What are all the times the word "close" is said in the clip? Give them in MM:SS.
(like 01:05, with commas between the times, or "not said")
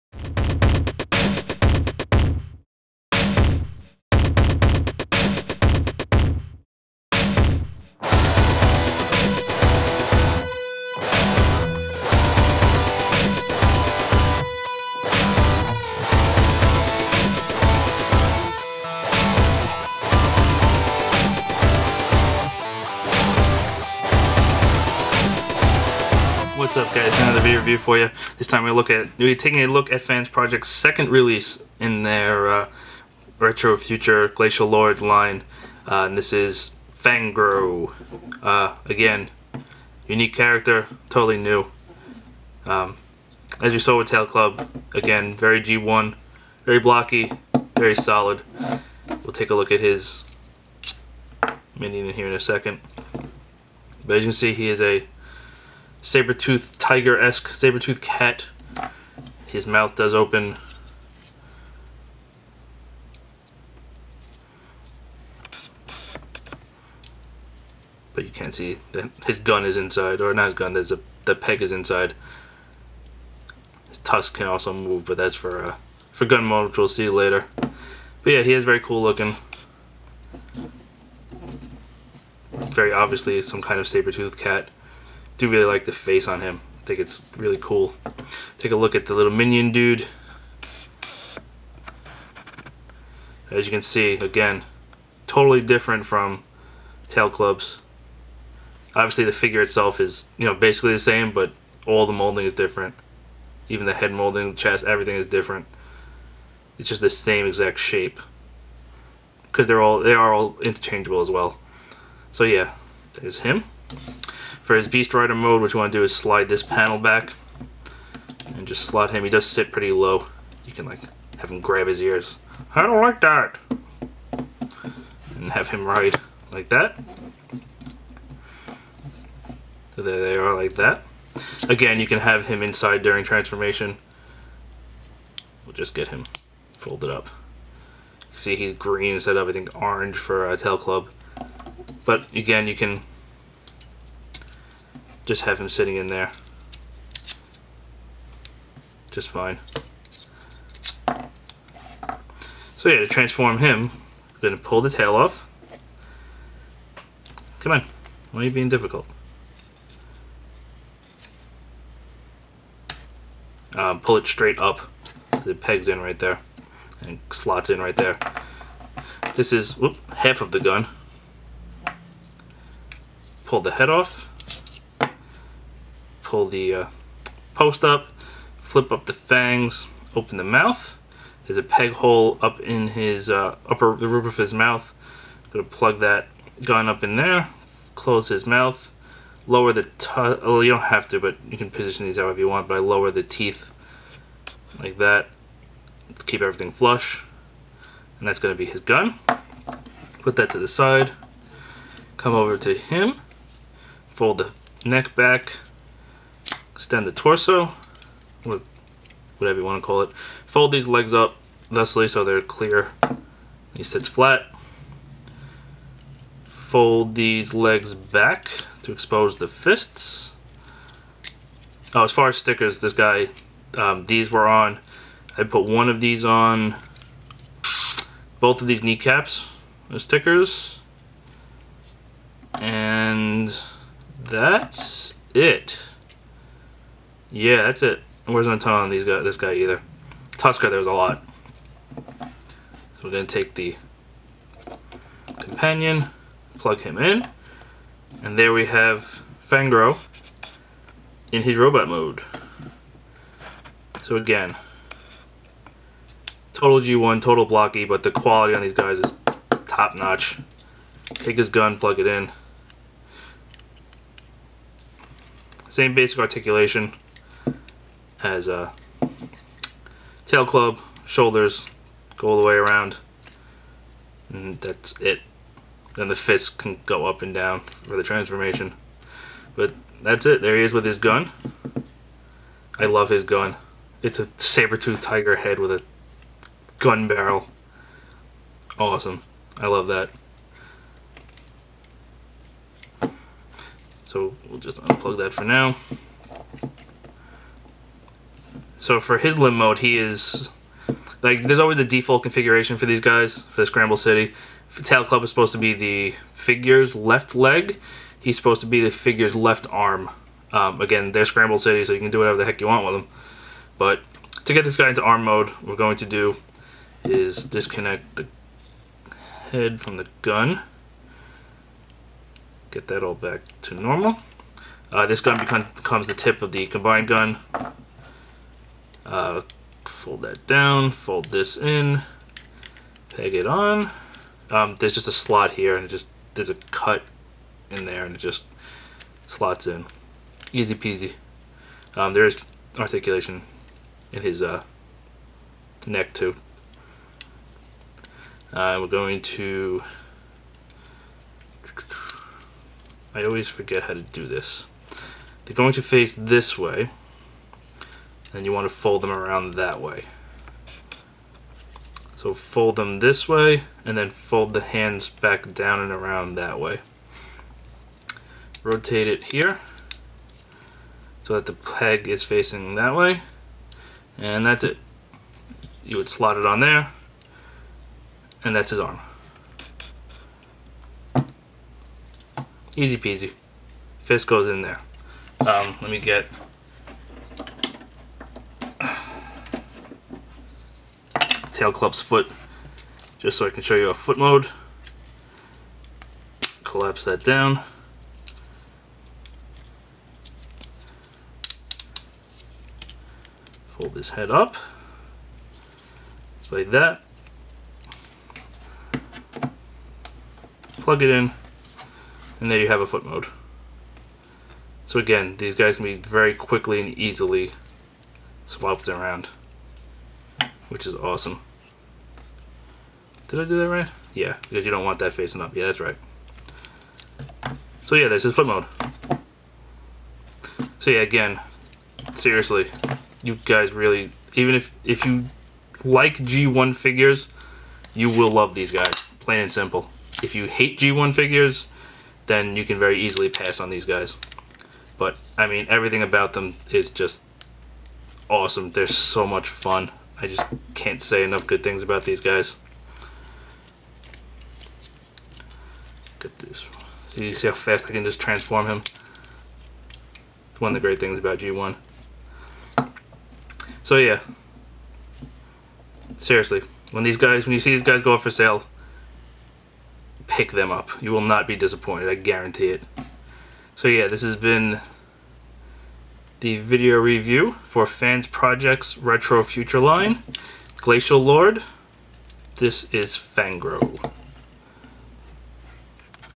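03:07.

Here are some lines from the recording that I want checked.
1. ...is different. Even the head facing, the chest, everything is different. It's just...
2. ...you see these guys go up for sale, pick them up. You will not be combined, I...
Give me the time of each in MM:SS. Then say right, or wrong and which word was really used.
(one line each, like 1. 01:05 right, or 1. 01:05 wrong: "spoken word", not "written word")
1. 01:42 wrong: "molding", not "facing"
2. 07:47 wrong: "disappointed", not "combined".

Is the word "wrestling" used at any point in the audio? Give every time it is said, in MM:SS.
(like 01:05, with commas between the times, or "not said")
not said.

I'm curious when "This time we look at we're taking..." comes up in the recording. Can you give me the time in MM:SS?
00:28.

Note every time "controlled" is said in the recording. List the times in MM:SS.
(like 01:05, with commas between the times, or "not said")
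not said.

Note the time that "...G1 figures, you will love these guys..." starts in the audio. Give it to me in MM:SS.
07:16.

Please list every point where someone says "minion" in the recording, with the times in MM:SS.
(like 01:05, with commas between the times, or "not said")
00:51, 01:29.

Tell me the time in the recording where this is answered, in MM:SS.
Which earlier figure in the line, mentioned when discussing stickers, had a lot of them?
04:00.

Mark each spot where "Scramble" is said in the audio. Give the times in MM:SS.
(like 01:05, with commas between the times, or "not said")
05:03, 05:11.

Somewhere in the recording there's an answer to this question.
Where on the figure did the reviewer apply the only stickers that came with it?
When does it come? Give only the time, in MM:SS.
03:48.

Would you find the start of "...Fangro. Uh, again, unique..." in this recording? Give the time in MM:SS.
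00:36.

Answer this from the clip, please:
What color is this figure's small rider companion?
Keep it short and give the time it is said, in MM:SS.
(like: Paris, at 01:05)
Green, at 02:18.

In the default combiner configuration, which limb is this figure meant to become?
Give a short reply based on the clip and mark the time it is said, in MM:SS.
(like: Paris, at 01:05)
Left arm, at 05:09.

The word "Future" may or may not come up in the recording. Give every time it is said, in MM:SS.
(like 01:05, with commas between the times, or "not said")
00:33, 07:59.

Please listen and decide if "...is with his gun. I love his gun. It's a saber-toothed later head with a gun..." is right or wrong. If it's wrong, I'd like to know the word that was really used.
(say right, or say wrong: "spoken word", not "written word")
wrong: "tiger", not "later".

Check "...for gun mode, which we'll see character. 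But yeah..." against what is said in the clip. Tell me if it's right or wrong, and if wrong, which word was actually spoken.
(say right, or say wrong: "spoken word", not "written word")
wrong: "later", not "character".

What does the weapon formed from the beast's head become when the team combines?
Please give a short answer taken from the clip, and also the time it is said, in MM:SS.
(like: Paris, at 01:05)
Tip of the combined gun, at 05:26.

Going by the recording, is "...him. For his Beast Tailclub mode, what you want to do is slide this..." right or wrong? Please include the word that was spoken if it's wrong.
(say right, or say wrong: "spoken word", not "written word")
wrong: "Rider", not "Tailclub".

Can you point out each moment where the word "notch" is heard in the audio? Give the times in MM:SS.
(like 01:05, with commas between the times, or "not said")
04:19.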